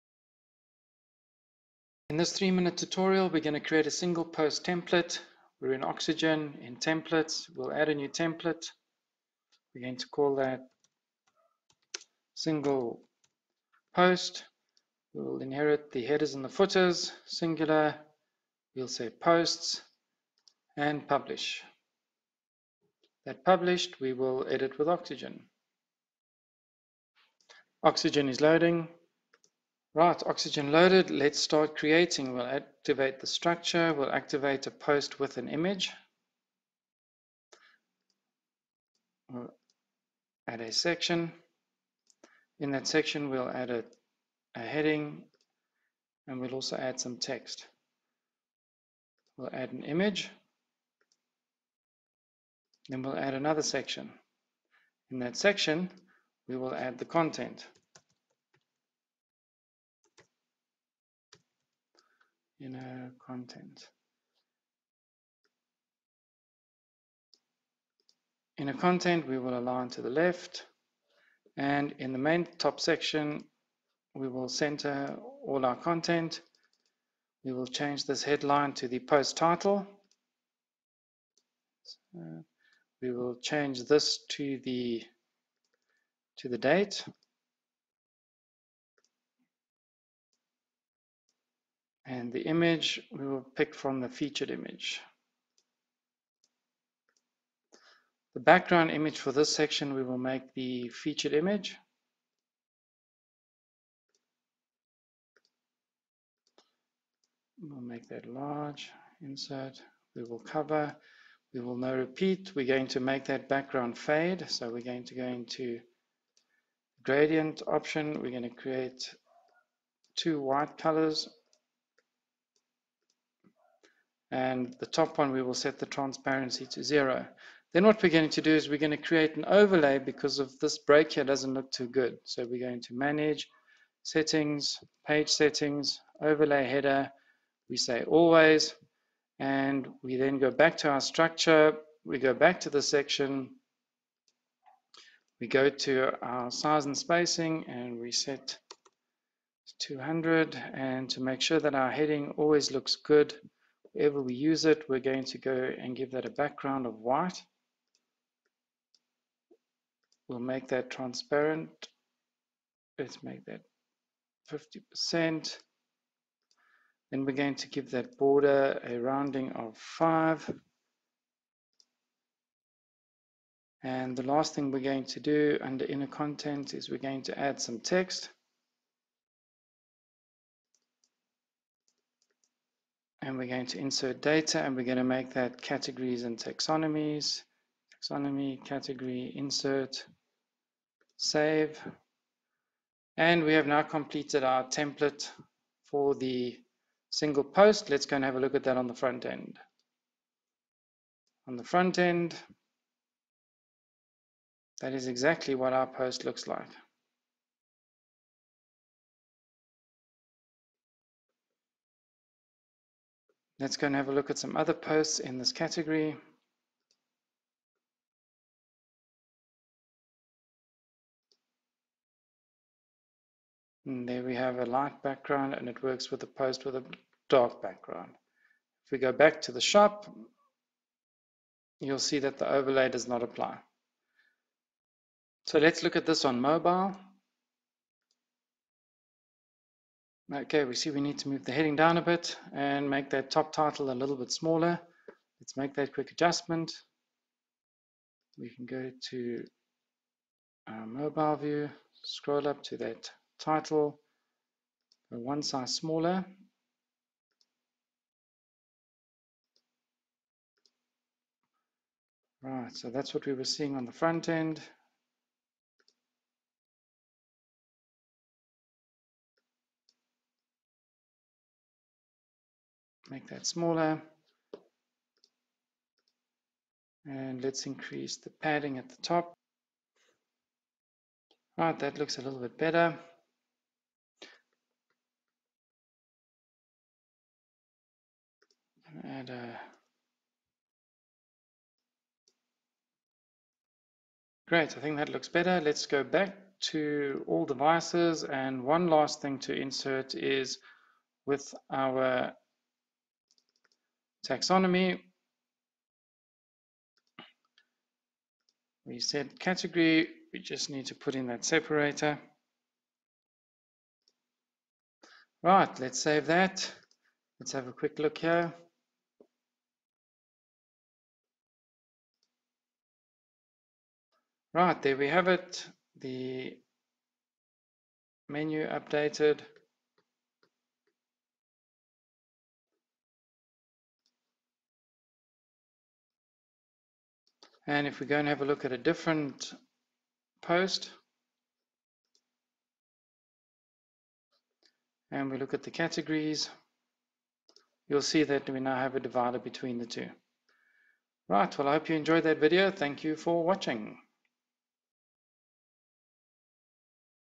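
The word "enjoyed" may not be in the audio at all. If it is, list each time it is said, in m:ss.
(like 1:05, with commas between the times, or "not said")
5:51.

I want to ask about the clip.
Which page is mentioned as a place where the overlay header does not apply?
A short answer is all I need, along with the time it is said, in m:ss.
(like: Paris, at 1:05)
the shop, at 3:49.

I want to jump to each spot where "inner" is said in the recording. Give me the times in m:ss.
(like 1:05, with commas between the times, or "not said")
1:02, 1:08, 2:55.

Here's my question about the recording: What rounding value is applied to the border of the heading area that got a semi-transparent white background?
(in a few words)
5.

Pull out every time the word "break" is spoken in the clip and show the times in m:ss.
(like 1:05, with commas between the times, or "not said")
2:10.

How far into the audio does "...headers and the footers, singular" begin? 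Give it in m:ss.
0:16.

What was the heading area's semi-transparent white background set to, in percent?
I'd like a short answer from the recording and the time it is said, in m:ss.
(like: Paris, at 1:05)
50%, at 2:44.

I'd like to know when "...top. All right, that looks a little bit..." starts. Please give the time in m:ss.
4:39.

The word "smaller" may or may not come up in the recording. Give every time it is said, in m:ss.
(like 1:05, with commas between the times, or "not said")
4:04, 4:15, 4:33.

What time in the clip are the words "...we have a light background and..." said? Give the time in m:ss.
3:44.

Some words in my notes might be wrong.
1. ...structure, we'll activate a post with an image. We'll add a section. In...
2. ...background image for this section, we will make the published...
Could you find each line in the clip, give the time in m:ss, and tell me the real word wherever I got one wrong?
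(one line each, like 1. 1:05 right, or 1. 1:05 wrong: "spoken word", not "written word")
1. 0:33 right
2. 1:38 wrong: "featured", not "published".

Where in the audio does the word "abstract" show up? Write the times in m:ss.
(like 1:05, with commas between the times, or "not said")
not said.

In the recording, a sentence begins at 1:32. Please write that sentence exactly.
And the image we will pick from the featured image.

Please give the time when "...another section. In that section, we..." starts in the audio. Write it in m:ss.
0:53.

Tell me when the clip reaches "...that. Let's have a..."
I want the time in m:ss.
5:16.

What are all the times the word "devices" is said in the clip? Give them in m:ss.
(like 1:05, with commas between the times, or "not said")
4:57.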